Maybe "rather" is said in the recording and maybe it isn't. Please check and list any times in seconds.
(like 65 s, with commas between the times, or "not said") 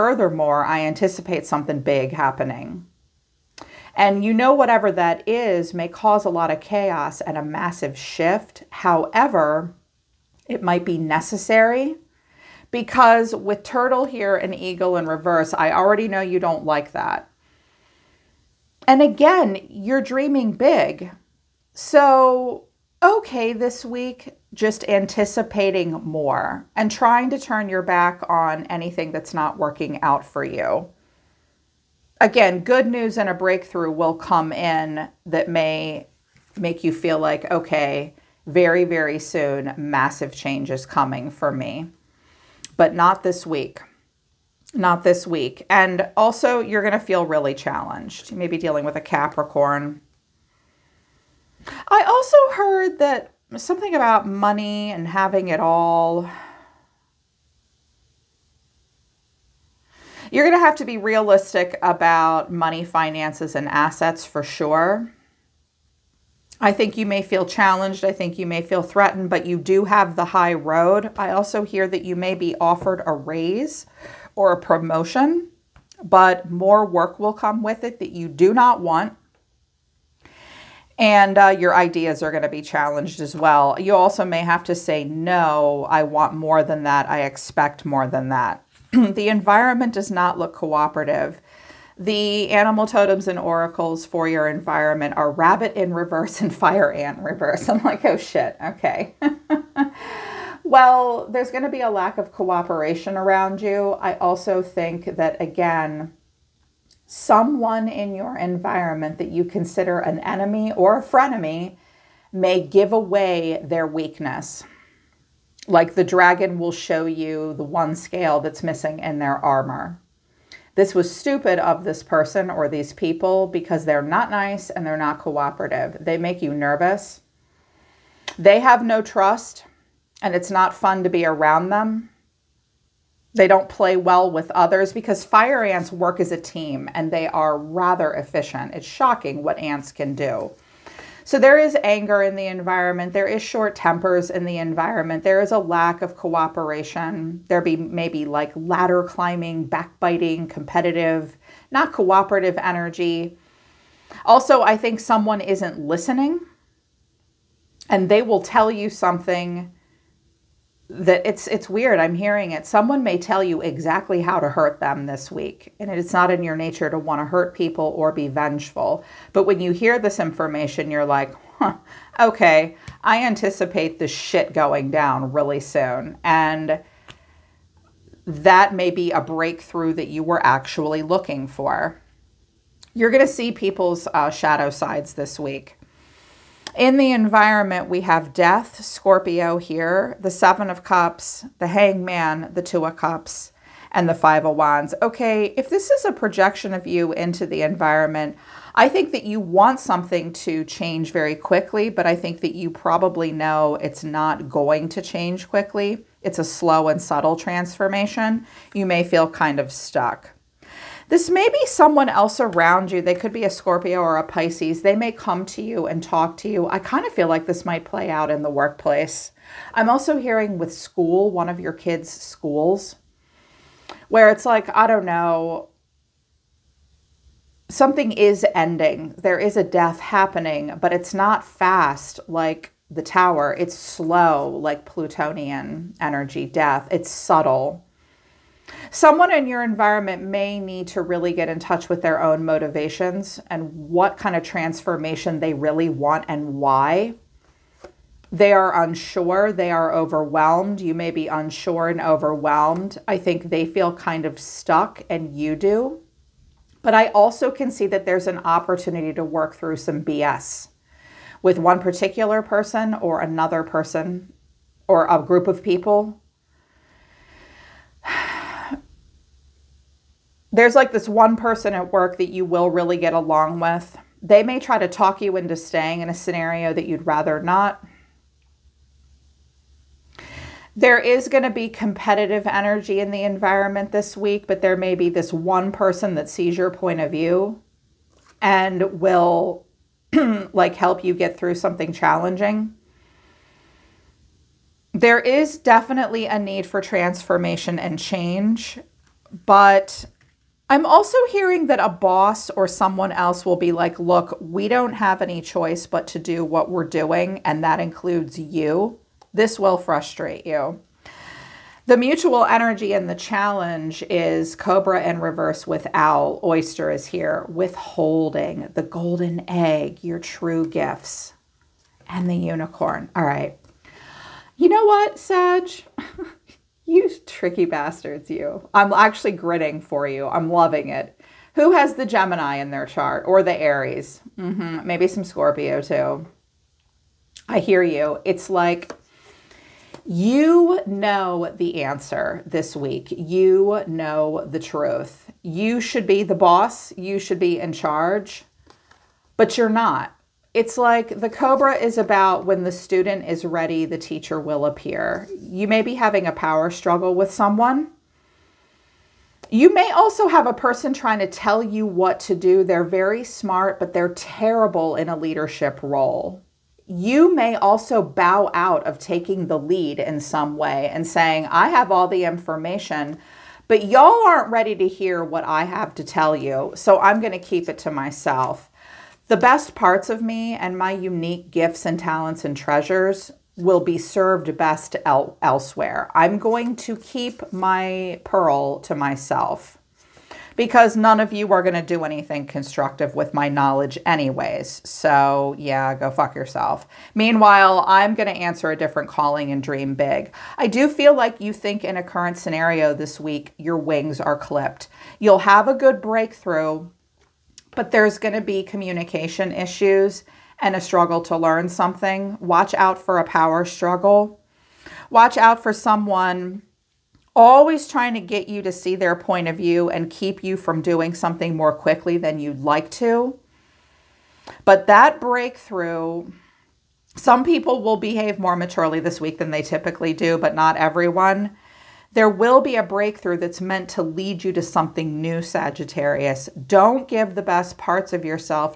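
137 s, 277 s.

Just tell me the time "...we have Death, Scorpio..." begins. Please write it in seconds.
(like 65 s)
187 s.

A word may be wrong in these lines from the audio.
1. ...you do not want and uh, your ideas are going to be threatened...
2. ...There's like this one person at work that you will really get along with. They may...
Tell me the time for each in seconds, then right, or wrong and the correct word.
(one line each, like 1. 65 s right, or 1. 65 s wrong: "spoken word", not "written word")
1. 78 s wrong: "challenged", not "threatened"
2. 270 s right.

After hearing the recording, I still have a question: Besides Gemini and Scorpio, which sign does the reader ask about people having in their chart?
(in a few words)
Aries.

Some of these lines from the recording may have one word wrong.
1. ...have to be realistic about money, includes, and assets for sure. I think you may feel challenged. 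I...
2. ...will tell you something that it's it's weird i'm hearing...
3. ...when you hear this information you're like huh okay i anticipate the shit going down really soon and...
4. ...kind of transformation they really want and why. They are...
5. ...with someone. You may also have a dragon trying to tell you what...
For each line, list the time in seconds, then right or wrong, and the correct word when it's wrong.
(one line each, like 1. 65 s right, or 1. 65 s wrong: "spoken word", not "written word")
1. 60 s wrong: "finances", not "includes"
2. 158 s right
3. 169 s right
4. 244 s right
5. 357 s wrong: "person", not "dragon".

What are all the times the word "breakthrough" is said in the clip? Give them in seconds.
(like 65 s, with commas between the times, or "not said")
33 s, 179 s, 406 s, 425 s, 432 s.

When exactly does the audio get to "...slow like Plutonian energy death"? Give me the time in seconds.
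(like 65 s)
233 s.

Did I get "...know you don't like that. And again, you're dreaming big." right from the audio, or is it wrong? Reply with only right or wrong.
right.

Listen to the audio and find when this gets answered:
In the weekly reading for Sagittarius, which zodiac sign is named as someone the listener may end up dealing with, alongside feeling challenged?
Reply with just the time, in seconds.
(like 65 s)
49 s.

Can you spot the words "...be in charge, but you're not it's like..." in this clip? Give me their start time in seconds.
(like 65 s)
347 s.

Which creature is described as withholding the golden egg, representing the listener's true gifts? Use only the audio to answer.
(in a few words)
Oyster.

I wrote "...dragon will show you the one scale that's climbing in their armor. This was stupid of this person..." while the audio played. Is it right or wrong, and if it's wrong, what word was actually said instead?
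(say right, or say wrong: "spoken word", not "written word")
wrong: "missing", not "climbing".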